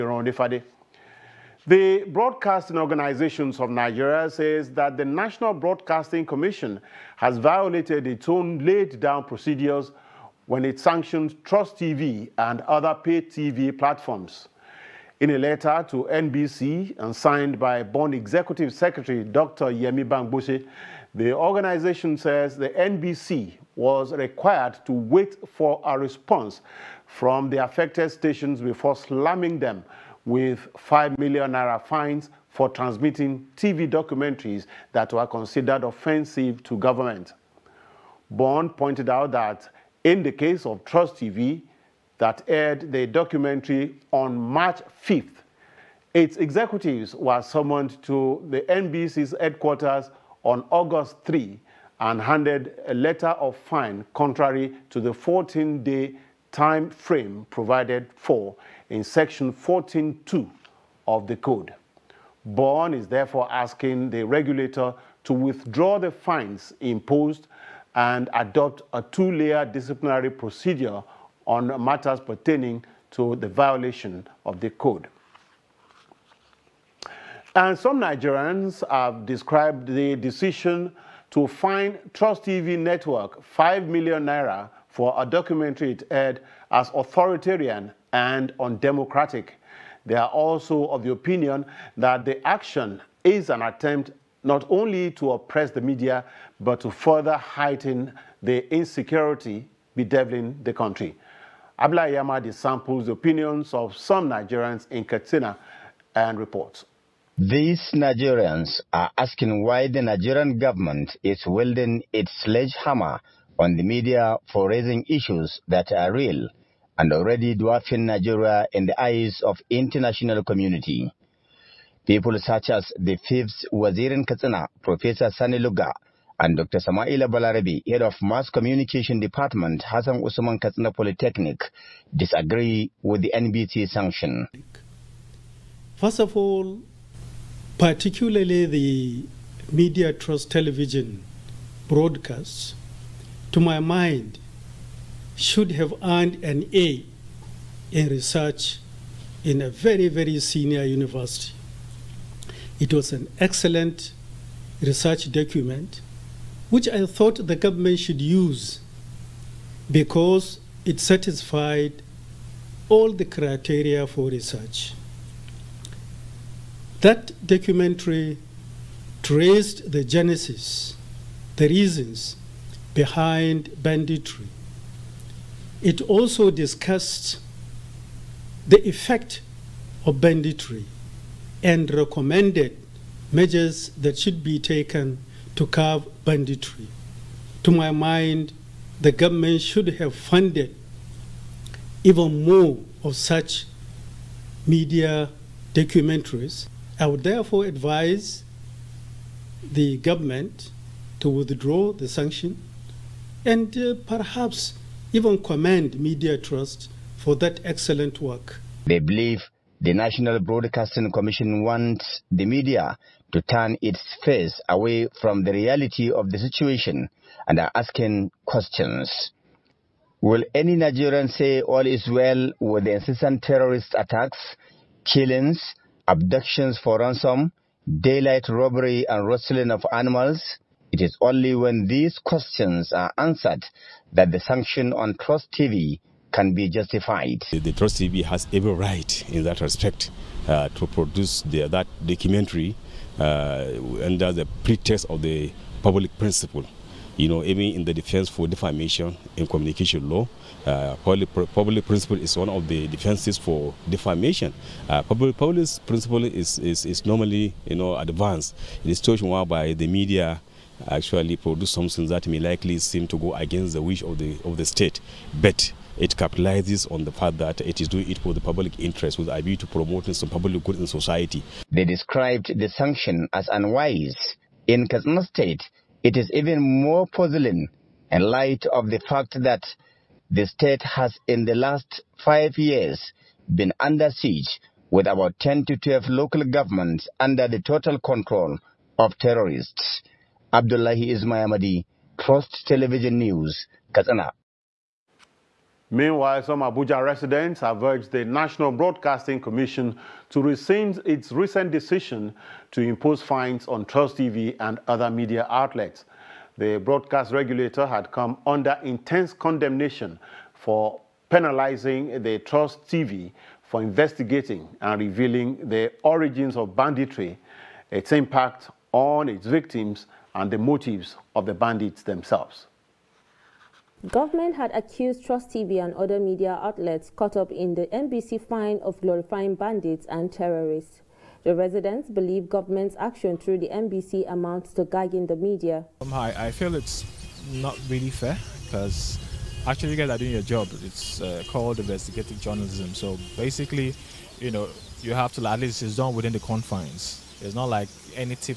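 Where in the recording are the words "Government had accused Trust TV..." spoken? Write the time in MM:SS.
05:24.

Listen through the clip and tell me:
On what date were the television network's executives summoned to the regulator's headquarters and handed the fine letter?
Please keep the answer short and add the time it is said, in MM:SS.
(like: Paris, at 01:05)
August 3, at 00:50.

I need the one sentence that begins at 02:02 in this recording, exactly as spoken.
People such as the fifth Wazirin Katsina, Professor Sani Lugga, and Dr.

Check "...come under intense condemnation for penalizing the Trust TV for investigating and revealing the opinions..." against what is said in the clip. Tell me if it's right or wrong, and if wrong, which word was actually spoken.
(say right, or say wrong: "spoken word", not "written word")
wrong: "origins", not "opinions".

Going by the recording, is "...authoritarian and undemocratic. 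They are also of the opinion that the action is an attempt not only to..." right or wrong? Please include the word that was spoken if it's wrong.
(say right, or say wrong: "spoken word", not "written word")
right.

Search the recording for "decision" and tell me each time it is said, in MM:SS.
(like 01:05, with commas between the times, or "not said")
01:20, 05:01.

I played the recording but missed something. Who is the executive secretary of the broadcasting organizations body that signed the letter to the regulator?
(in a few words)
Dr. Yemi Bamgbose.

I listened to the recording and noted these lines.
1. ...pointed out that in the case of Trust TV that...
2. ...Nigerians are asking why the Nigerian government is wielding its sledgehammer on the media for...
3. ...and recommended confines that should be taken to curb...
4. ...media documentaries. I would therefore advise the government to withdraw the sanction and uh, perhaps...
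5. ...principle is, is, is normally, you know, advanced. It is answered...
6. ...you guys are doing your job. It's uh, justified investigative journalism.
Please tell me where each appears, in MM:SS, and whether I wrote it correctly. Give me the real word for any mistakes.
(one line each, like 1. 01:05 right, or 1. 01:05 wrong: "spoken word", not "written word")
1. 00:38 right
2. 01:47 right
3. 03:01 wrong: "measures", not "confines"
4. 03:14 right
5. 04:15 wrong: "touched", not "answered"
6. 05:39 wrong: "called", not "justified".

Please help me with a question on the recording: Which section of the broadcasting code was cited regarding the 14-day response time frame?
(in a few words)
14.2.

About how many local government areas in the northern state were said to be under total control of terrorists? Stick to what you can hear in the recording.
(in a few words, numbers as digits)
10 to 12.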